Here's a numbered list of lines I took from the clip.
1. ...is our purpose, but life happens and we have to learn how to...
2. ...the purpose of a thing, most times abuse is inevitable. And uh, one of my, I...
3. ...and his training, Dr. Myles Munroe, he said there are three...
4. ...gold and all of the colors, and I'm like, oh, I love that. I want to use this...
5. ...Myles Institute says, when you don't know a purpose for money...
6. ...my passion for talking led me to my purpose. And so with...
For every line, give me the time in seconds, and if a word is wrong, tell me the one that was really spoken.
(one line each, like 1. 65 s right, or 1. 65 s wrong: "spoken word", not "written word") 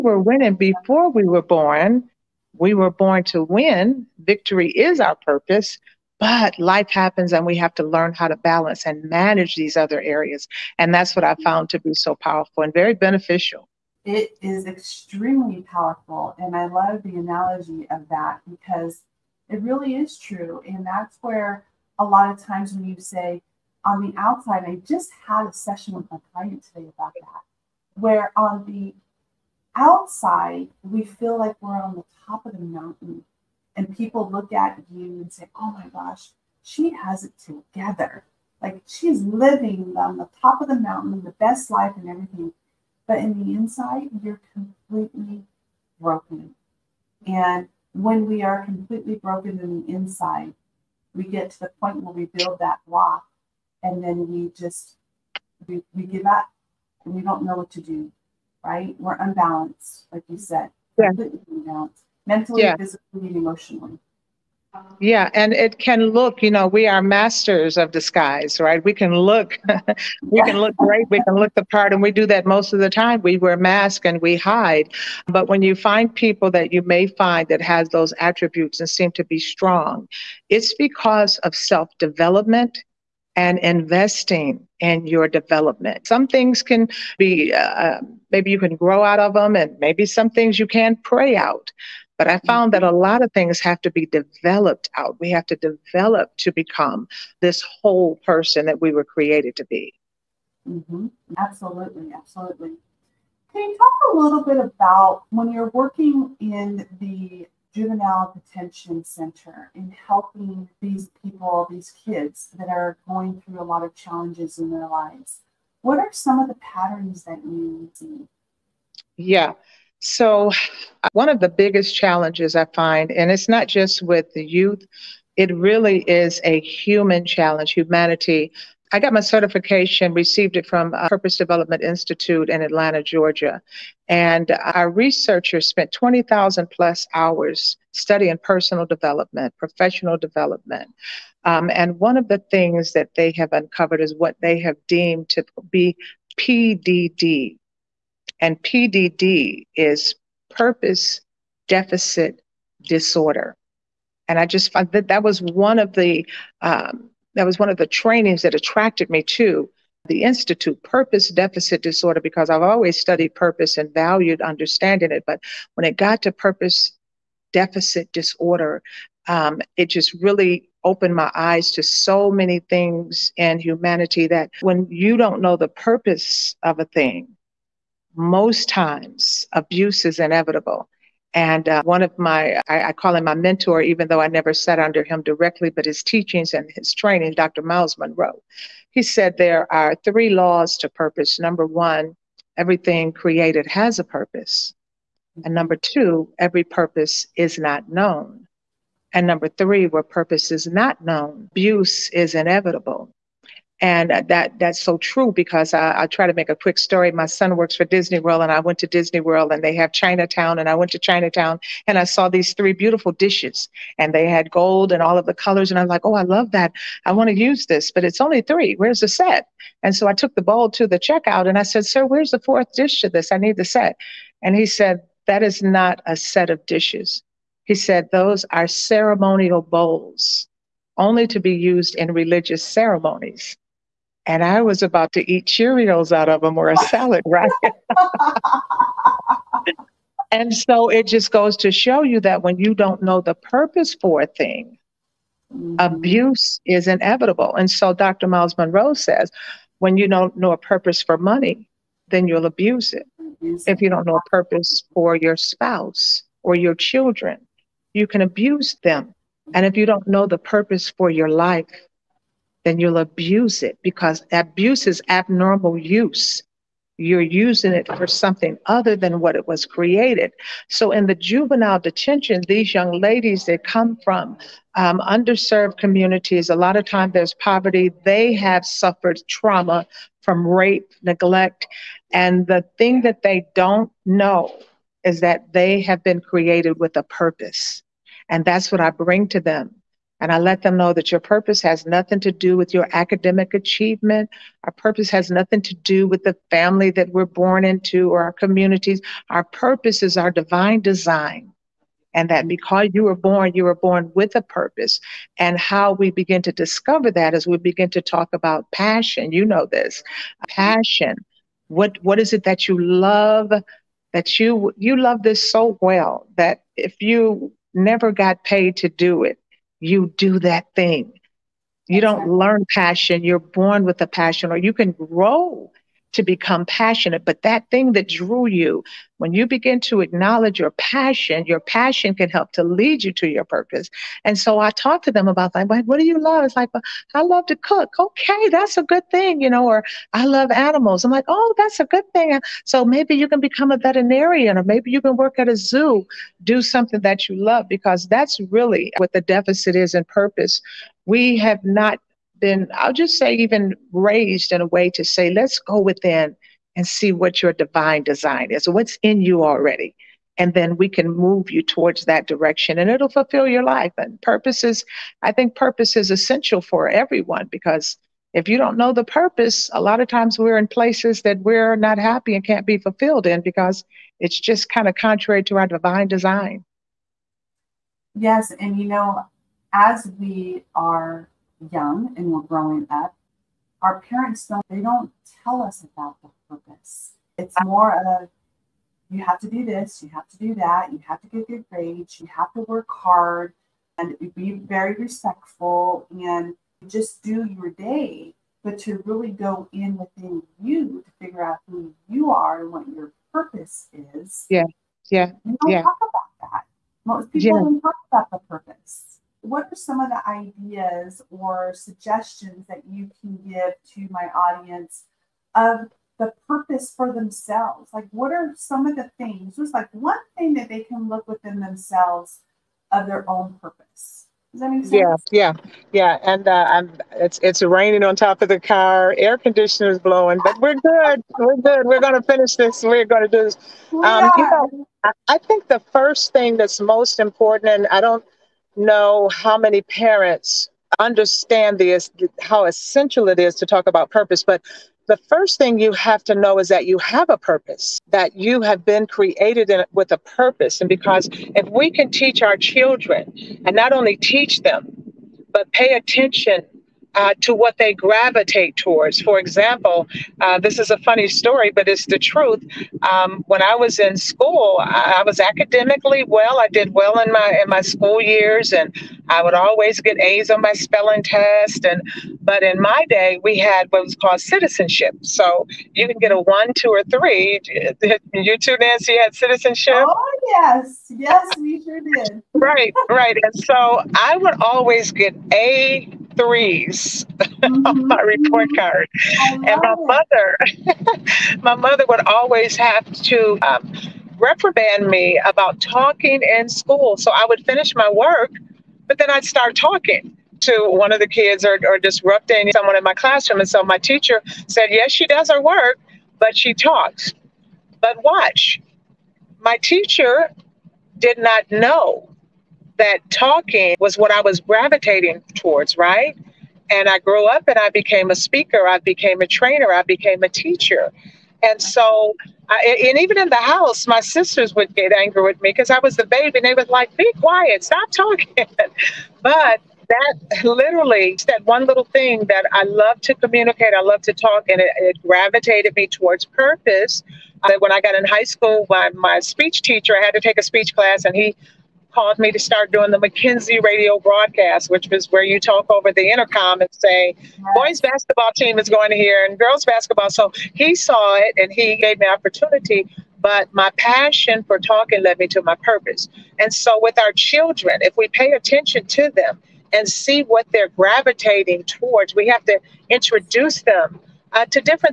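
1. 4 s right
2. 175 s right
3. 186 s right
4. 214 s right
5. 248 s wrong: "Munroe", not "Institute"
6. 553 s right.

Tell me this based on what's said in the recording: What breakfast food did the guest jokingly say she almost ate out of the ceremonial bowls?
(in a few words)
Cheerios.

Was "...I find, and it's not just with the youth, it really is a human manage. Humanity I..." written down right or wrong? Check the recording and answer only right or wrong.
wrong.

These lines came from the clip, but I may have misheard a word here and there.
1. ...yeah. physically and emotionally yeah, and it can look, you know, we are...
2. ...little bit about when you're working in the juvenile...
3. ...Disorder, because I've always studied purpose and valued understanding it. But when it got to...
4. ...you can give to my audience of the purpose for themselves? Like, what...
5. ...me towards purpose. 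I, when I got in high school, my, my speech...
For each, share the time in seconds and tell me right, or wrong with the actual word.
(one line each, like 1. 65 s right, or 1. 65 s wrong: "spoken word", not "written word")
1. 62 s right
2. 104 s right
3. 161 s right
4. 412 s right
5. 535 s right.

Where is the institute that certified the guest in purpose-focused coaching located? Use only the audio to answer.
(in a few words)
Atlanta, Georgia.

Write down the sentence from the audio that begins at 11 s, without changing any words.
found to be so powerful and very beneficial.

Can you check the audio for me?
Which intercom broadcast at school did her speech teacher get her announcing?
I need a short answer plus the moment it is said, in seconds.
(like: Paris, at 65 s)
McKinsey radio broadcast, at 543 s.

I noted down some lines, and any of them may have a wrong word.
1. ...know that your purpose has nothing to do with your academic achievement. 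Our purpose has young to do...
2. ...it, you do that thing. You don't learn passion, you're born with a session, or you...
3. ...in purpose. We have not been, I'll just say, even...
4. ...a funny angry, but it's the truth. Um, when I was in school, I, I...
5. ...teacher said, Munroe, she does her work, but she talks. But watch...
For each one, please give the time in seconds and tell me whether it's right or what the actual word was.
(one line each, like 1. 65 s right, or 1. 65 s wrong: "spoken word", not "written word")
1. 290 s wrong: "nothing", not "young"
2. 319 s wrong: "passion", not "session"
3. 349 s right
4. 460 s wrong: "story", not "angry"
5. 503 s wrong: "Yes", not "Munroe".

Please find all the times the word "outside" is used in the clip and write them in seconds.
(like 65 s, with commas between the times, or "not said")
24 s, 29 s.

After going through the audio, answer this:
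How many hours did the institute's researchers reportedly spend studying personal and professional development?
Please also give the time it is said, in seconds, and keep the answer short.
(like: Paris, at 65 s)
20,000, at 135 s.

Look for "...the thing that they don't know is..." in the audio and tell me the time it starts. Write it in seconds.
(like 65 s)
282 s.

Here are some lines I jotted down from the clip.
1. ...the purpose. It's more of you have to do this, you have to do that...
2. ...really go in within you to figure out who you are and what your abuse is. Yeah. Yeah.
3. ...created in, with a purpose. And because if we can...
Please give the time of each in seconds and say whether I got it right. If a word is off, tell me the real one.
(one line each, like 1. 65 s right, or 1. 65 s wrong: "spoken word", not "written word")
1. 386 s right
2. 399 s wrong: "purpose", not "abuse"
3. 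449 s right.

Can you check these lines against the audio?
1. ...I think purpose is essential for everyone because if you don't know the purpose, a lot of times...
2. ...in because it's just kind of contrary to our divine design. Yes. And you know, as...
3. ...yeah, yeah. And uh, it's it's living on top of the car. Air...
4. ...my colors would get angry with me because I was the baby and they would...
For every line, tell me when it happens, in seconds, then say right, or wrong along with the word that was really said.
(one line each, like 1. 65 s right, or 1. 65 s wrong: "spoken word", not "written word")
1. 365 s right
2. 373 s right
3. 425 s wrong: "raining", not "living"
4. 524 s wrong: "sisters", not "colors".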